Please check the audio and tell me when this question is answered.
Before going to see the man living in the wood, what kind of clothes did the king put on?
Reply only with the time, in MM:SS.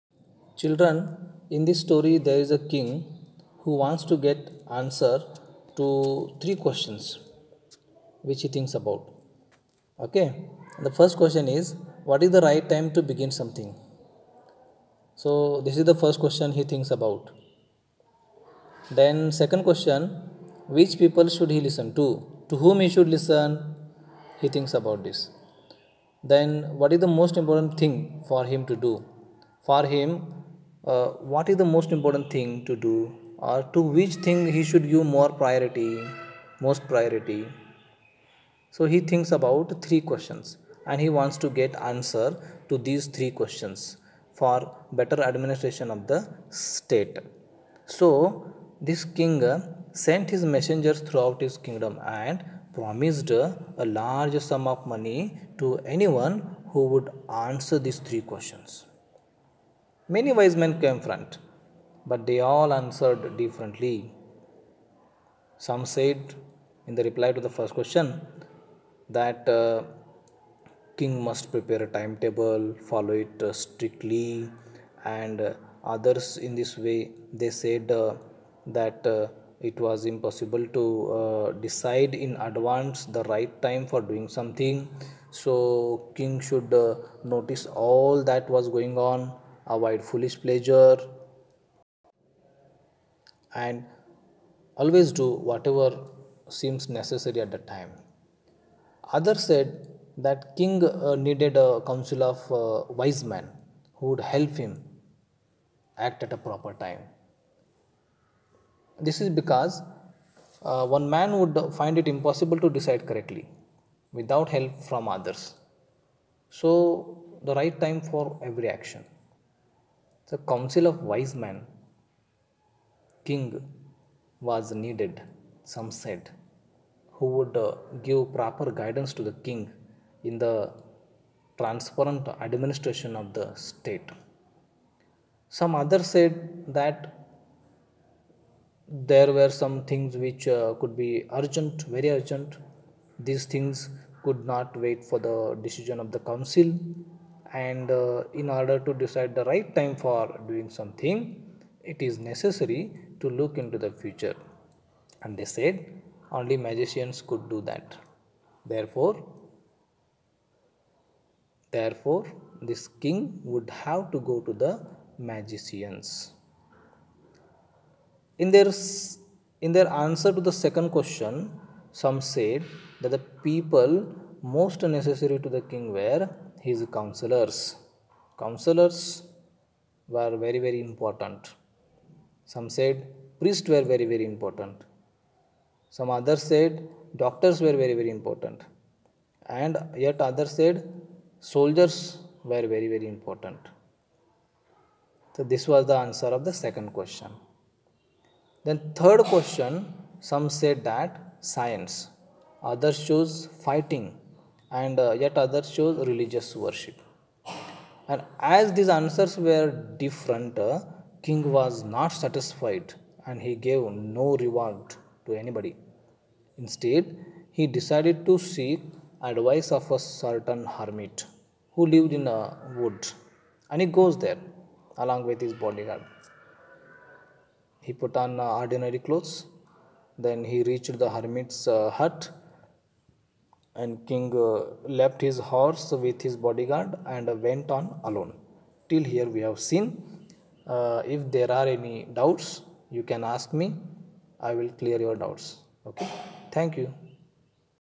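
03:48.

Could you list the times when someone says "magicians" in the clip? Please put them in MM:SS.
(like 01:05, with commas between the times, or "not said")
02:36, 02:45.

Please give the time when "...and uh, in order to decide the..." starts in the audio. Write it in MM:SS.
02:27.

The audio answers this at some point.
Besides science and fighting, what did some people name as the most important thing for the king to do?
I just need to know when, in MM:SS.
03:26.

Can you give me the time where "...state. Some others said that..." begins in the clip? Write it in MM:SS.
02:13.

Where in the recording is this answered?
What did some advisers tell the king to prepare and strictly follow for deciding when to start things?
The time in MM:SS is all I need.
01:11.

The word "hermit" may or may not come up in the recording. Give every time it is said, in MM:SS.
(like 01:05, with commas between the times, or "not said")
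03:40, 03:51.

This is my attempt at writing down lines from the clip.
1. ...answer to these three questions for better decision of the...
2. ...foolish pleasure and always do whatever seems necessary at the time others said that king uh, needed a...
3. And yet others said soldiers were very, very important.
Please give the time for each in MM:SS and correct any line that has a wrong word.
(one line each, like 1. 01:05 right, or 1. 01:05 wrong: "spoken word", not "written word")
1. 00:41 wrong: "administration", not "decision"
2. 01:30 right
3. 03:09 right.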